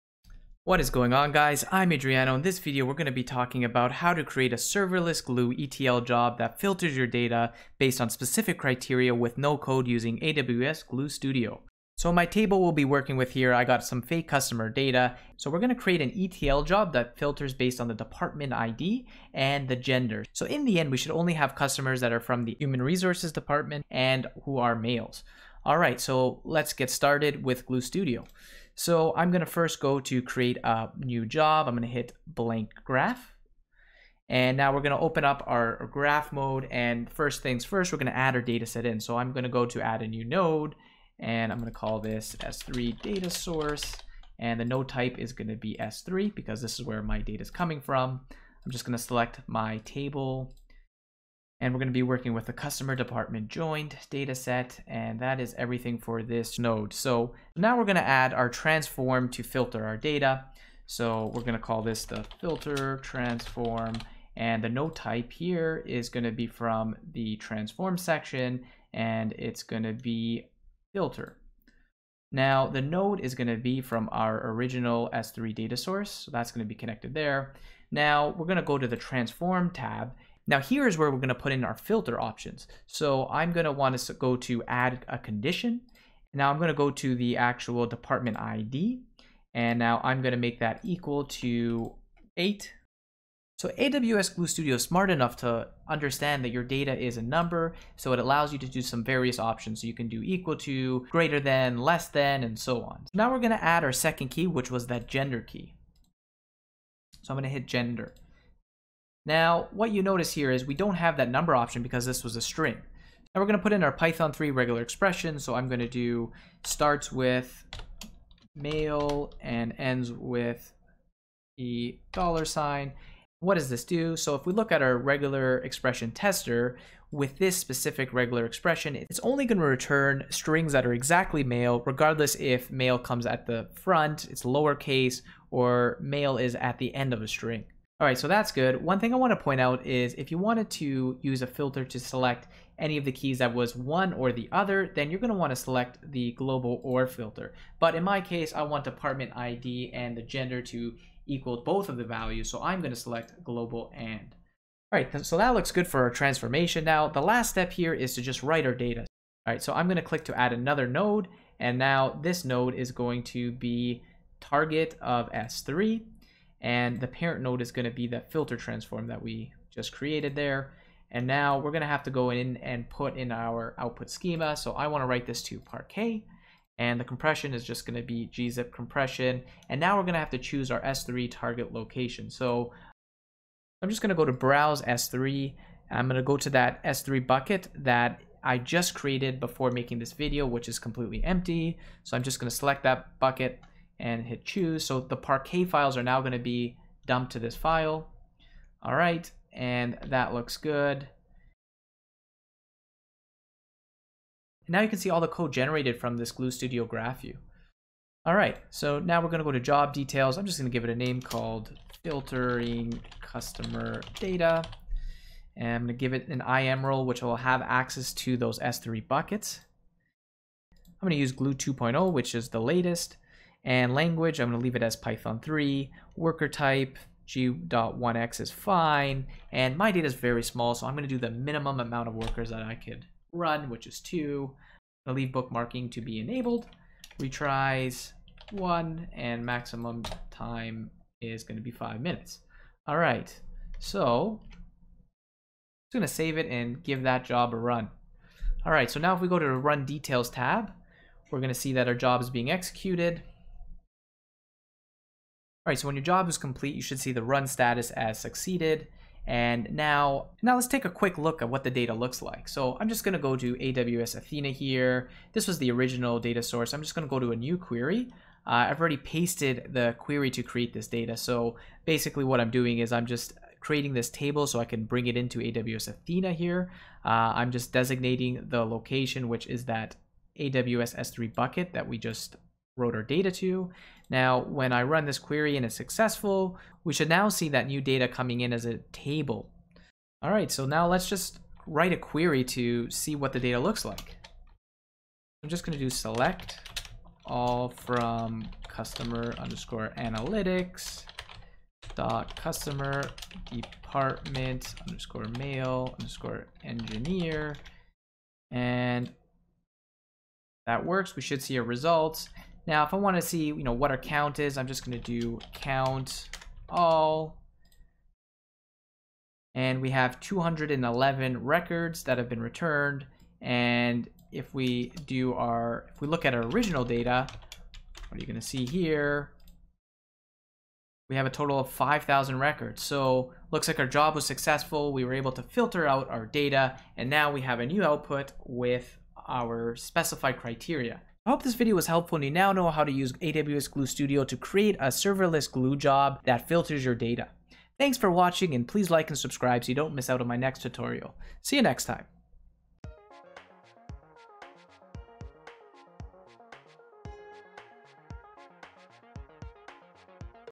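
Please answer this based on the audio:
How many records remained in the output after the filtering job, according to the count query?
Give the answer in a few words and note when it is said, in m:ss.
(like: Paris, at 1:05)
211, at 5:20.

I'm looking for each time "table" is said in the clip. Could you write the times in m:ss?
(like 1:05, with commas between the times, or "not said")
0:12, 0:49, 4:34, 4:48.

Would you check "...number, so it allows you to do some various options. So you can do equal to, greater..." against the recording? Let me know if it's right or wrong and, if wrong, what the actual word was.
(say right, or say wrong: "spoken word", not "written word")
right.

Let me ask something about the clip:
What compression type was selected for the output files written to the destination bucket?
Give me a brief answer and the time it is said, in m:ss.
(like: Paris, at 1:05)
gzip, at 2:58.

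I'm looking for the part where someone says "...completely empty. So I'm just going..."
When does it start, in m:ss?
3:10.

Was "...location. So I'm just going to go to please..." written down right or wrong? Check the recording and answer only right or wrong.
wrong.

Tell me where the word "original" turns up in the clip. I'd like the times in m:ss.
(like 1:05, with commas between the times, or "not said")
1:14, 4:25, 5:26.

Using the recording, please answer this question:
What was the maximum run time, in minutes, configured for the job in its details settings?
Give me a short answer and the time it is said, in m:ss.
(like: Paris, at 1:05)
5, at 4:01.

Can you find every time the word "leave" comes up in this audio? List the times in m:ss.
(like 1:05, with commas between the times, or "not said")
3:44, 3:55.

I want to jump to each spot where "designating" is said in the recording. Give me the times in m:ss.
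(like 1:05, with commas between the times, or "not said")
4:37.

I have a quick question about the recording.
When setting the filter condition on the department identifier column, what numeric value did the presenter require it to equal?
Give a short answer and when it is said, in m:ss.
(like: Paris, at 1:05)
8, at 1:32.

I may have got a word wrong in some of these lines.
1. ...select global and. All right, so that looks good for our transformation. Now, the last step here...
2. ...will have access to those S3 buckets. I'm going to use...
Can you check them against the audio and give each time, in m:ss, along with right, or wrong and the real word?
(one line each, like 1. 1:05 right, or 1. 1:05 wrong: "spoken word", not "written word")
1. 2:32 right
2. 3:37 right.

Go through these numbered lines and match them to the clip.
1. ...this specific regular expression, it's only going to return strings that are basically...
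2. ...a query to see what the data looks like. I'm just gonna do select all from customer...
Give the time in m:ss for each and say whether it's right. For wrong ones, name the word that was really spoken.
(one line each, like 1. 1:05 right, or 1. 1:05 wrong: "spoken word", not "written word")
1. 2:07 wrong: "exactly", not "basically"
2. 4:51 right.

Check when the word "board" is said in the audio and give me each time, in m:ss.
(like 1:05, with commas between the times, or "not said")
not said.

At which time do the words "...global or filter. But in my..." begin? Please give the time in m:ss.
2:26.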